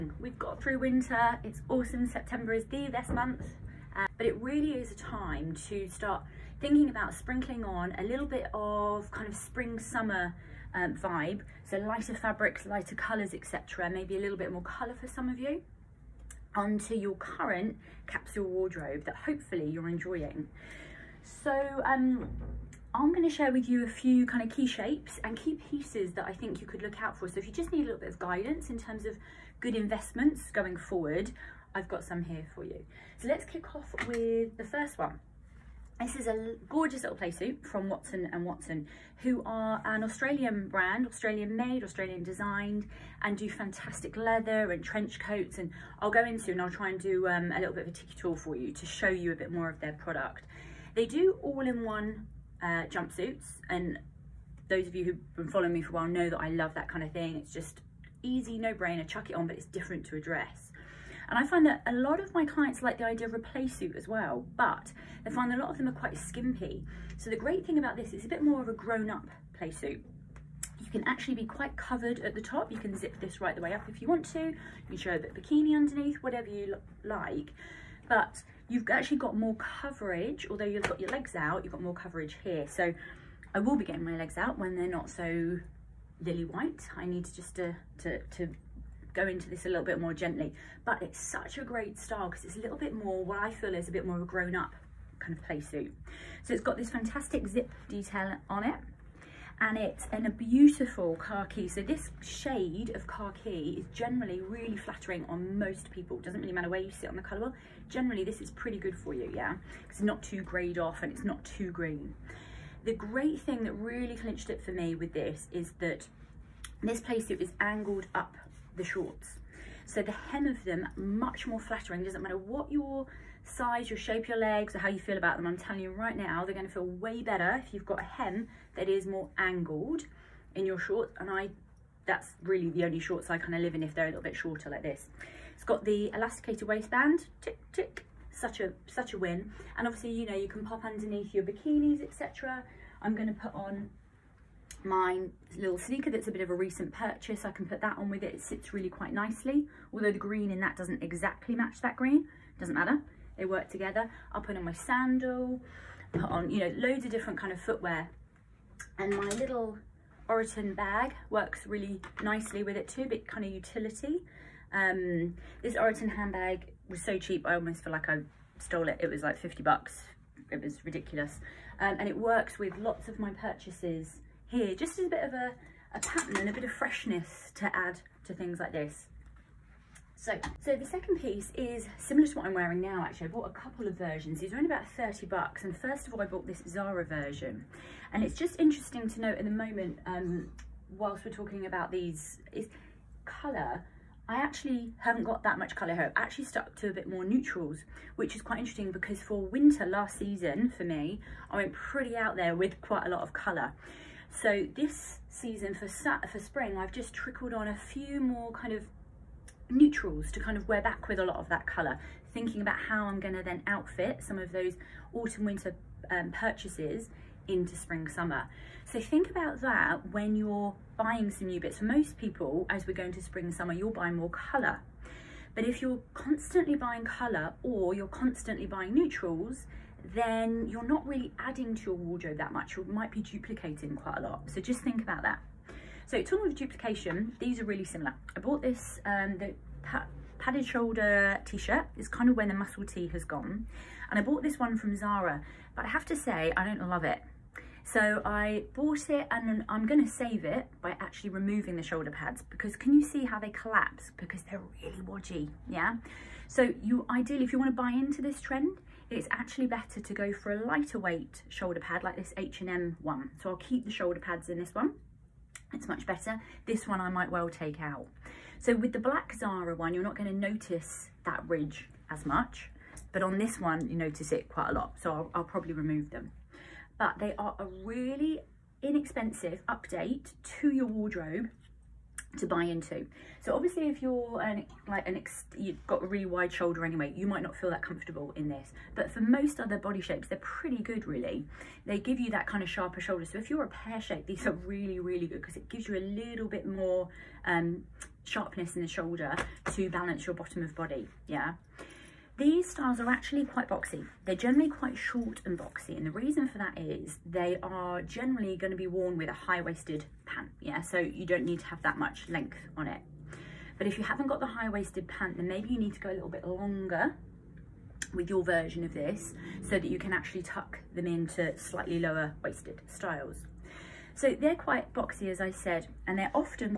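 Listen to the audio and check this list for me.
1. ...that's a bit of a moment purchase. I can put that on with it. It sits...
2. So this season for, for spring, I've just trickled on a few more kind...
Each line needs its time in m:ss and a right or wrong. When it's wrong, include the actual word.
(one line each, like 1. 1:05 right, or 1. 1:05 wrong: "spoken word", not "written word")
1. 2:26 wrong: "recent", not "moment"
2. 3:24 right.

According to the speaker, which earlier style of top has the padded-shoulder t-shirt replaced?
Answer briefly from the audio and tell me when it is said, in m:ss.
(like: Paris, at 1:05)
Muscle tee, at 4:02.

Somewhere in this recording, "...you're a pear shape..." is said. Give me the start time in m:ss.
4:53.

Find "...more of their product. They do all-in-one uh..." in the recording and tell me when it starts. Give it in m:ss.
0:49.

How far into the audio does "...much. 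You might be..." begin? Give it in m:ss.
3:52.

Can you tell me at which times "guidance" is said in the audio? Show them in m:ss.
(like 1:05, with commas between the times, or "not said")
0:28.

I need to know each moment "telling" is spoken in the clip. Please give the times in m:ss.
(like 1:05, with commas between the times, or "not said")
2:05.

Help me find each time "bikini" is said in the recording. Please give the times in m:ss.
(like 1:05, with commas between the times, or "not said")
1:15, 2:21.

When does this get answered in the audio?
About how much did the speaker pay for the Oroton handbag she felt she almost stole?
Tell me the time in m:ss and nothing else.
2:49.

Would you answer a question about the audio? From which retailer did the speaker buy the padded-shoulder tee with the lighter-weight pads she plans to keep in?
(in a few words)
H&M.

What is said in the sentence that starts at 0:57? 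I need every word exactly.
It's just easy, no-brainer, chuck it on, but it's different to a dress.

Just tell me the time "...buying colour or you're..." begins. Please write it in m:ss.
3:46.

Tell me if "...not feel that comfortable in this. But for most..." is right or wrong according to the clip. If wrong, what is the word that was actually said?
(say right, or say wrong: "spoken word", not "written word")
right.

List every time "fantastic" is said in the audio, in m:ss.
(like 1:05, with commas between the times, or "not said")
0:43, 1:36.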